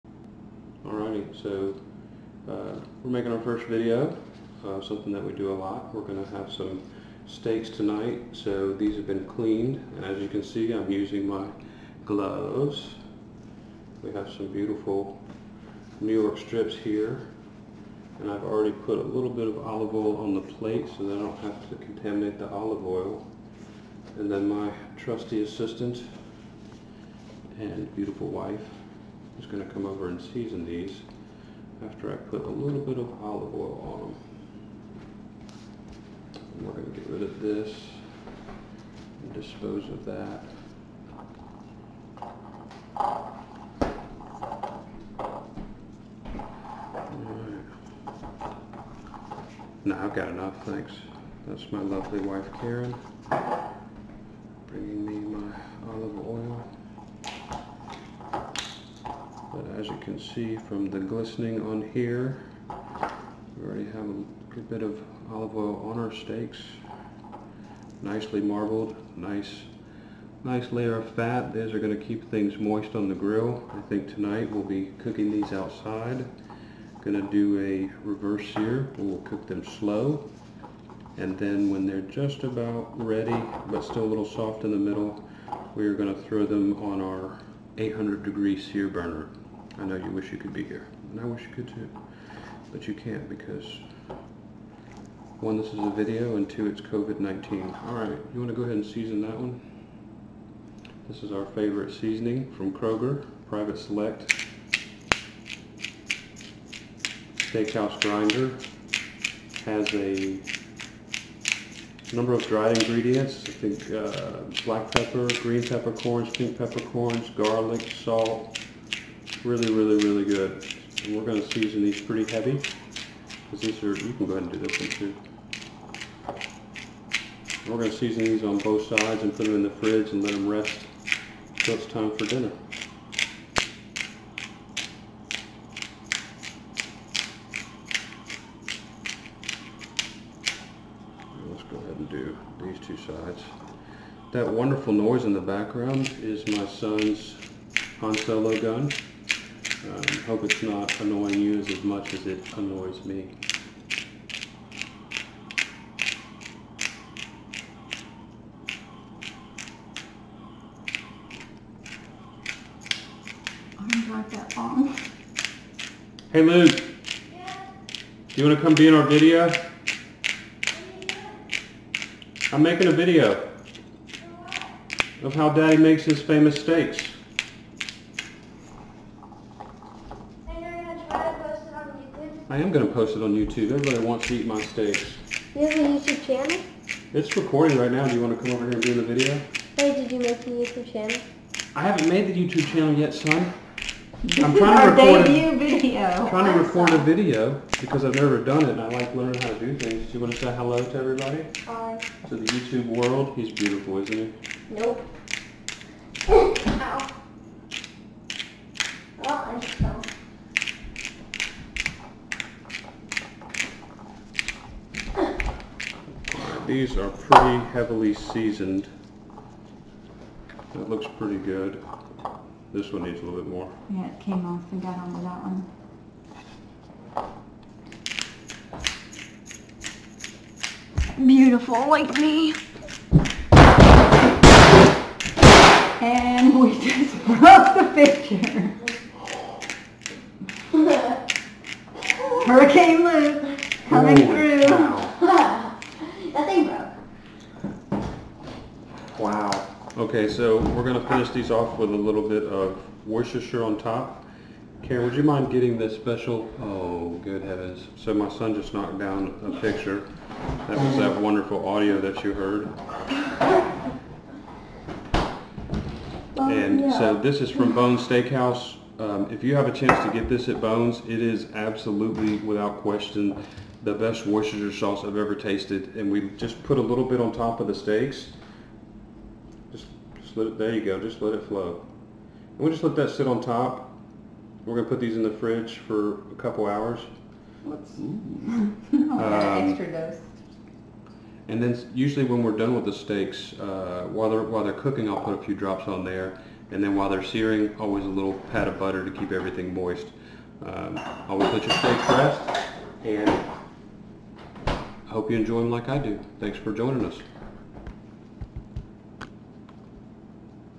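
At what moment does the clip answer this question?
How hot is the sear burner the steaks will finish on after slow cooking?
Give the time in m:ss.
1:27.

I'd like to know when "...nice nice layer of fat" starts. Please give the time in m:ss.
1:09.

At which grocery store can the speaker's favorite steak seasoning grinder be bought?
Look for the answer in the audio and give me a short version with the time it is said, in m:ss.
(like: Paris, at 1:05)
Kroger, at 1:42.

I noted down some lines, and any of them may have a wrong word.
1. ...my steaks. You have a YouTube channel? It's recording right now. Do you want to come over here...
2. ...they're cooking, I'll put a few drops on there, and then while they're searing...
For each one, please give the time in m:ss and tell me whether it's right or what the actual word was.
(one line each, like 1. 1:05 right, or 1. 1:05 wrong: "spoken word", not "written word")
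1. 3:04 right
2. 4:54 right.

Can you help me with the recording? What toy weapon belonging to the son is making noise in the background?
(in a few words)
Han Solo gun.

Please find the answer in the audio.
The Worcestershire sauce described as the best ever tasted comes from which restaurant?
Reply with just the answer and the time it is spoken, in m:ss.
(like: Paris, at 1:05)
Bones Steakhouse, at 4:27.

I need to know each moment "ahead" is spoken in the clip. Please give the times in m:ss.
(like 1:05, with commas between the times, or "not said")
1:38, 2:04, 2:21.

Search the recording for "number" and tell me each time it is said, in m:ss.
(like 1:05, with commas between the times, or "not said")
1:52.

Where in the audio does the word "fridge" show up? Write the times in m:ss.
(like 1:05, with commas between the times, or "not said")
2:09, 4:45.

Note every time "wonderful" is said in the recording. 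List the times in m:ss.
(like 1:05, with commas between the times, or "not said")
2:24, 4:21.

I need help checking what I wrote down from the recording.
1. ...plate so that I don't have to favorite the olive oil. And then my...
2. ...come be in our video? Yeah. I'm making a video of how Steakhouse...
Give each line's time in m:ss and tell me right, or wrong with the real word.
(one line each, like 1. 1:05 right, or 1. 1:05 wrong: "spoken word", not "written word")
1. 0:20 wrong: "contaminate", not "favorite"
2. 2:48 wrong: "Daddy", not "Steakhouse".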